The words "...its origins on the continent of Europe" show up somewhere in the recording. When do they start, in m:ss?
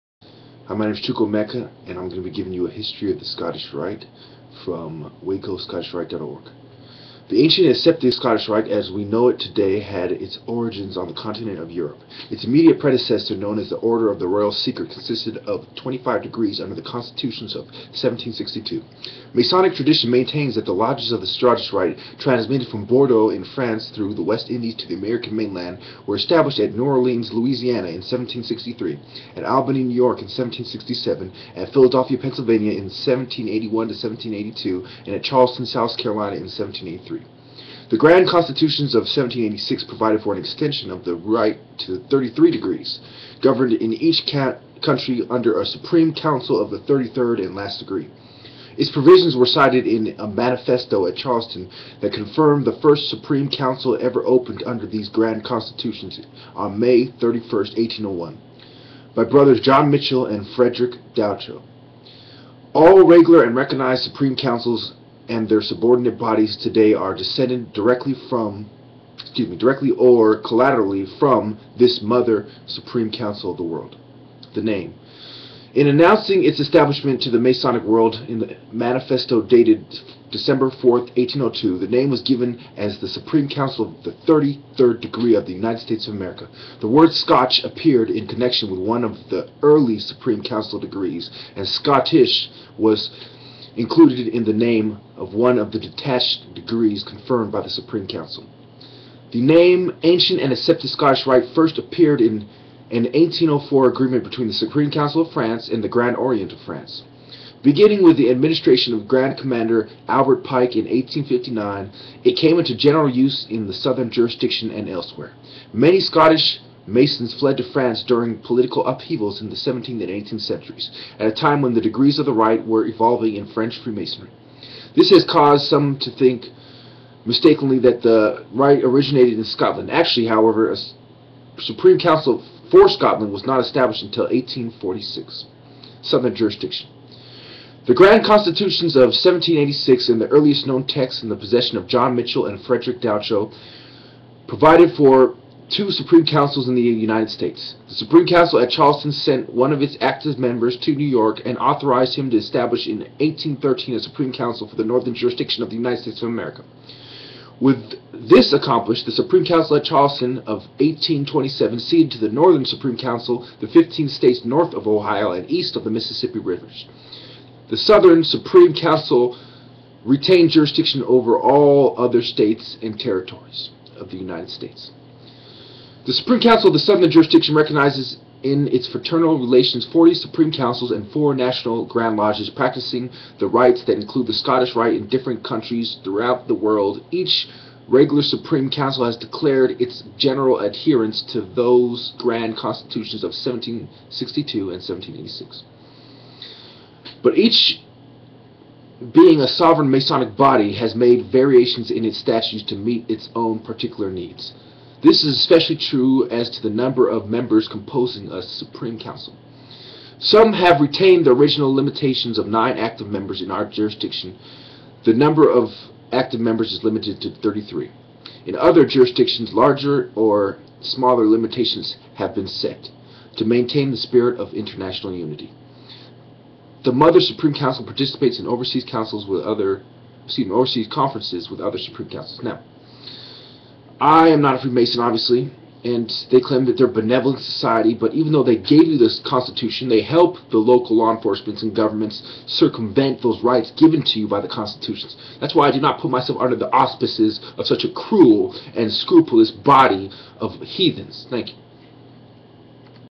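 0:10.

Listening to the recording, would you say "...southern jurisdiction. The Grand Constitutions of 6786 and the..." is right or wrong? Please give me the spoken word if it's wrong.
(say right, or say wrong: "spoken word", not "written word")
wrong: "1786", not "6786".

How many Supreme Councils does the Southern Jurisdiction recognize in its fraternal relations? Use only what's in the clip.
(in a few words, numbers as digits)
40.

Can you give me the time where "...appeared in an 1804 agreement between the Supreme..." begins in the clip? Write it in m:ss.
1:41.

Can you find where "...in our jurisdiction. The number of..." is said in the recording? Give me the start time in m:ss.
3:33.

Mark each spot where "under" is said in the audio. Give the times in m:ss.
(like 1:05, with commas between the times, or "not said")
0:16, 0:45, 0:54, 4:06.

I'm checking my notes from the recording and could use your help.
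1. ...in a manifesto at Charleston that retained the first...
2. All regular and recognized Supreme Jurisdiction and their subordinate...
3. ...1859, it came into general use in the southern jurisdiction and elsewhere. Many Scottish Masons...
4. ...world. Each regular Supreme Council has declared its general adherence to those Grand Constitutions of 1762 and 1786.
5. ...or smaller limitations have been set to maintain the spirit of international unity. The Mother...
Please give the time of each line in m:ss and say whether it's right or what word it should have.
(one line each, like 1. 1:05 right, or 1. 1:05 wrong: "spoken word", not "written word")
1. 0:49 wrong: "confirmed", not "retained"
2. 1:02 wrong: "Councils", not "Jurisdiction"
3. 1:50 right
4. 3:06 right
5. 3:40 right.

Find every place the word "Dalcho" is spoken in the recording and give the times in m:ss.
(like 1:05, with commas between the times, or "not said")
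1:01, 2:23.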